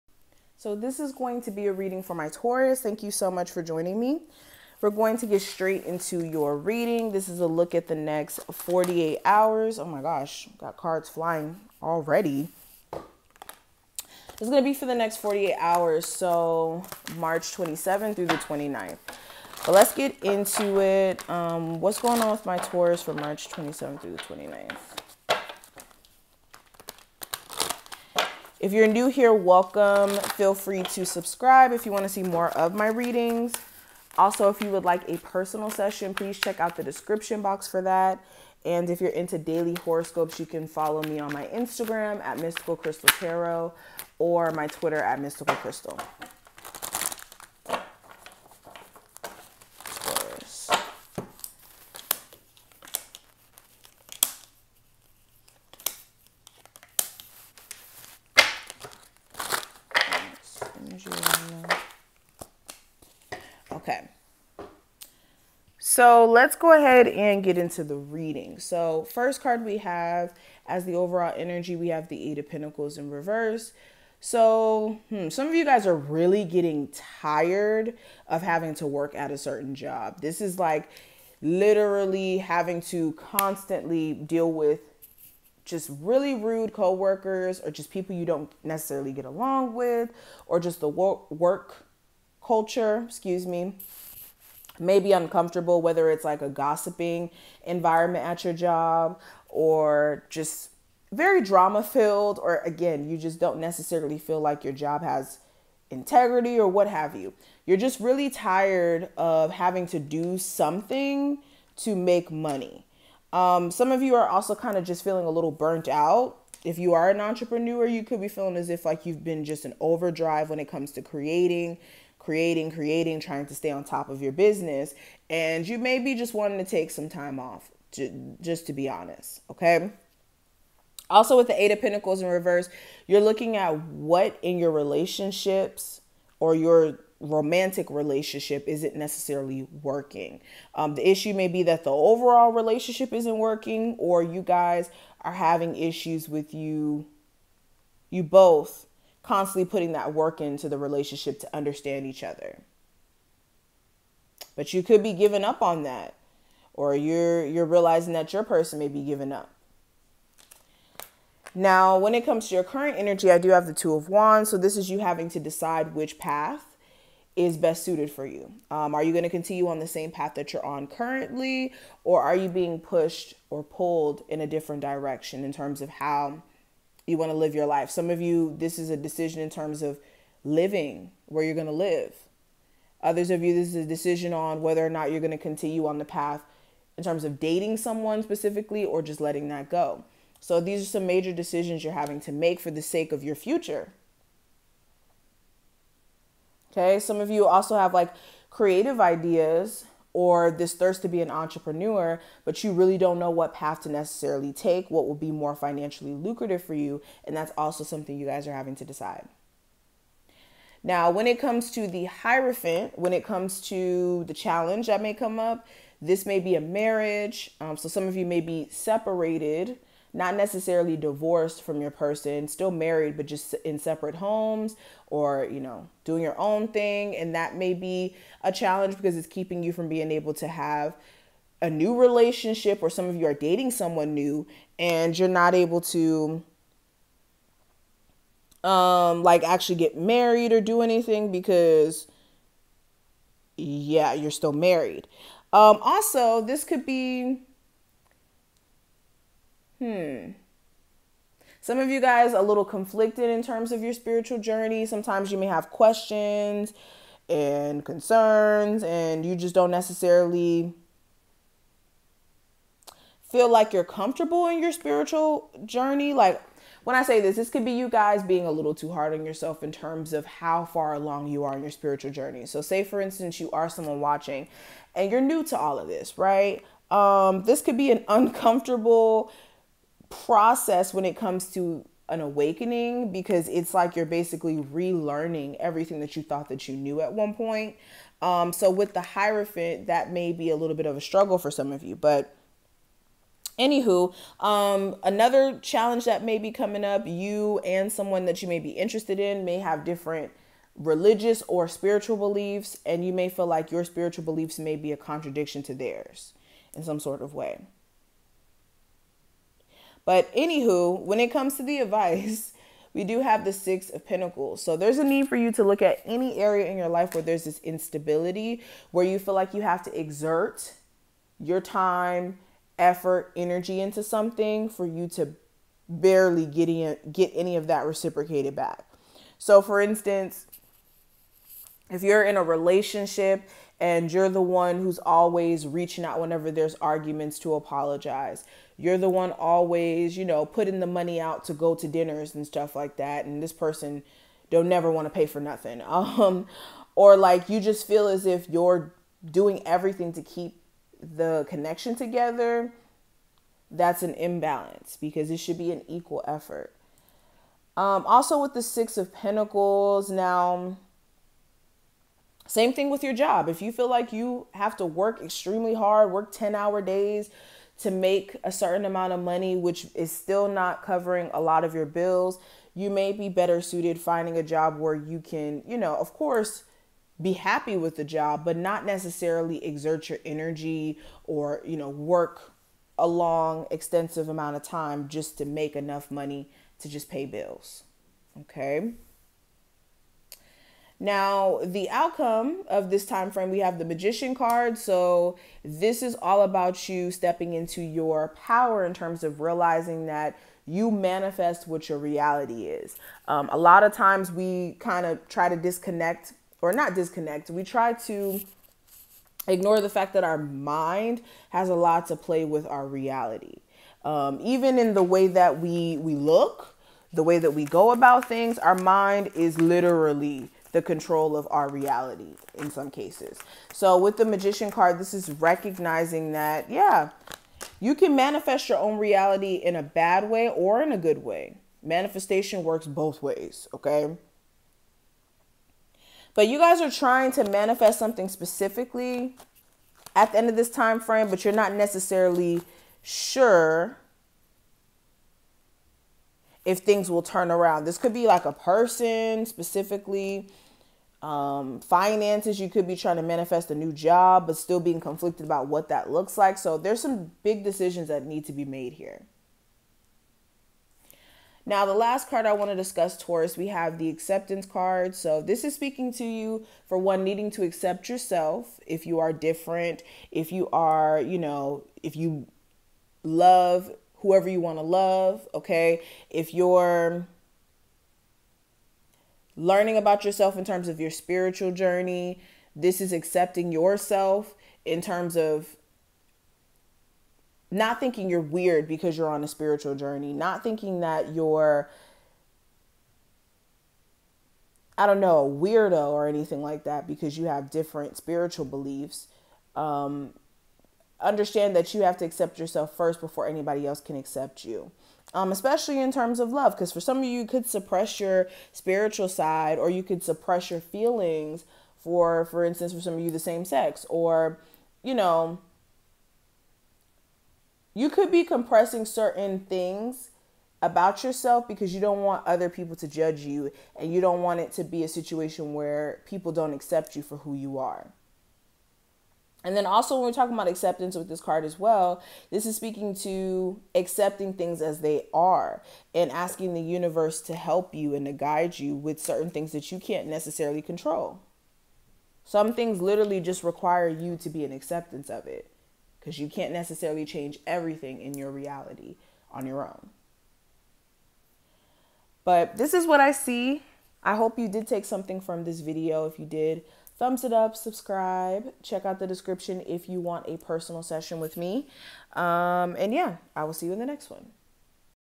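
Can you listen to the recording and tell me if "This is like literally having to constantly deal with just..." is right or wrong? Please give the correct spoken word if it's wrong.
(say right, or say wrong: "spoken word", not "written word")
right.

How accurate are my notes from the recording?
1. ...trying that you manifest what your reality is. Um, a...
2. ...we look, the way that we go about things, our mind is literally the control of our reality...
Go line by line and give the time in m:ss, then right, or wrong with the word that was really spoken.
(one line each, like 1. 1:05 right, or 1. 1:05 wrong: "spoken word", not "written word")
1. 6:39 wrong: "realizing", not "trying"
2. 6:55 right.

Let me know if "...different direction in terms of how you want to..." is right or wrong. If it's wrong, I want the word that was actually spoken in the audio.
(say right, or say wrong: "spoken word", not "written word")
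right.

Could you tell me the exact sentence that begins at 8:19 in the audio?
Um, understand that you have to accept yourself first before anybody else can accept you.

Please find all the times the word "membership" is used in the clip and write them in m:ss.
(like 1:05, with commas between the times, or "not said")
not said.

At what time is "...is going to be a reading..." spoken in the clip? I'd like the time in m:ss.
0:00.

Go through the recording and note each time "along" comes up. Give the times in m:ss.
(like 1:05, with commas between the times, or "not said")
1:29, 4:30.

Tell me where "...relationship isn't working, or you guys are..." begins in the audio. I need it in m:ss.
2:22.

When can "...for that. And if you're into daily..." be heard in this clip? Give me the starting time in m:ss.
0:37.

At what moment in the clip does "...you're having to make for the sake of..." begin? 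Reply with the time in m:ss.
3:11.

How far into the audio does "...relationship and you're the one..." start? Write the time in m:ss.
5:32.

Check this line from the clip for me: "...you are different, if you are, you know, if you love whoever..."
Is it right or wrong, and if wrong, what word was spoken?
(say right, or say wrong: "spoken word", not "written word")
right.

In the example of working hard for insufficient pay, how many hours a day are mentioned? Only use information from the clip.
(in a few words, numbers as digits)
10.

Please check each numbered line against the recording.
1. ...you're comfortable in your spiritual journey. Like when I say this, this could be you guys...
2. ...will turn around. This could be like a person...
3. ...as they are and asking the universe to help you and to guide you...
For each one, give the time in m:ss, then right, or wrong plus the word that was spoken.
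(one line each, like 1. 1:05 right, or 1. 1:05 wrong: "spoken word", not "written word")
1. 4:23 right
2. 7:27 right
3. 8:54 right.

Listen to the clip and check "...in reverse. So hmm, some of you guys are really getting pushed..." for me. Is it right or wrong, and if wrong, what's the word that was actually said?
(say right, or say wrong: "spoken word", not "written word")
wrong: "tired", not "pushed".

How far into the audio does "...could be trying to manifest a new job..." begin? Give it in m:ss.
7:32.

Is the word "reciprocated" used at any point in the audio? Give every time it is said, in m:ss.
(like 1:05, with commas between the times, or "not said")
5:27.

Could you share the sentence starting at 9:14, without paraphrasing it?
I hope you did take something from this video.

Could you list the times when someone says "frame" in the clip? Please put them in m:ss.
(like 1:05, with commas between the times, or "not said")
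6:33, 7:20.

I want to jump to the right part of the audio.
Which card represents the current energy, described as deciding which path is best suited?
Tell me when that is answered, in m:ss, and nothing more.
2:43.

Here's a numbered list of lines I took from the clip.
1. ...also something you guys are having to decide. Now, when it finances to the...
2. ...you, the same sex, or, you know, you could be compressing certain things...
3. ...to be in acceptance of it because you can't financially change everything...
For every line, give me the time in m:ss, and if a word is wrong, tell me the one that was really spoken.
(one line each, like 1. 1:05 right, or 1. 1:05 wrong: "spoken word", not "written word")
1. 3:27 wrong: "comes", not "finances"
2. 8:33 right
3. 9:04 wrong: "necessarily", not "financially".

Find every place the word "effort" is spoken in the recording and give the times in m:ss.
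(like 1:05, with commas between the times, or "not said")
5:22, 5:56.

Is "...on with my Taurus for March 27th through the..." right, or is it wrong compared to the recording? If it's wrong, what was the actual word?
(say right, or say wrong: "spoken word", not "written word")
right.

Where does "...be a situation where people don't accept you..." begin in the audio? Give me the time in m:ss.
8:44.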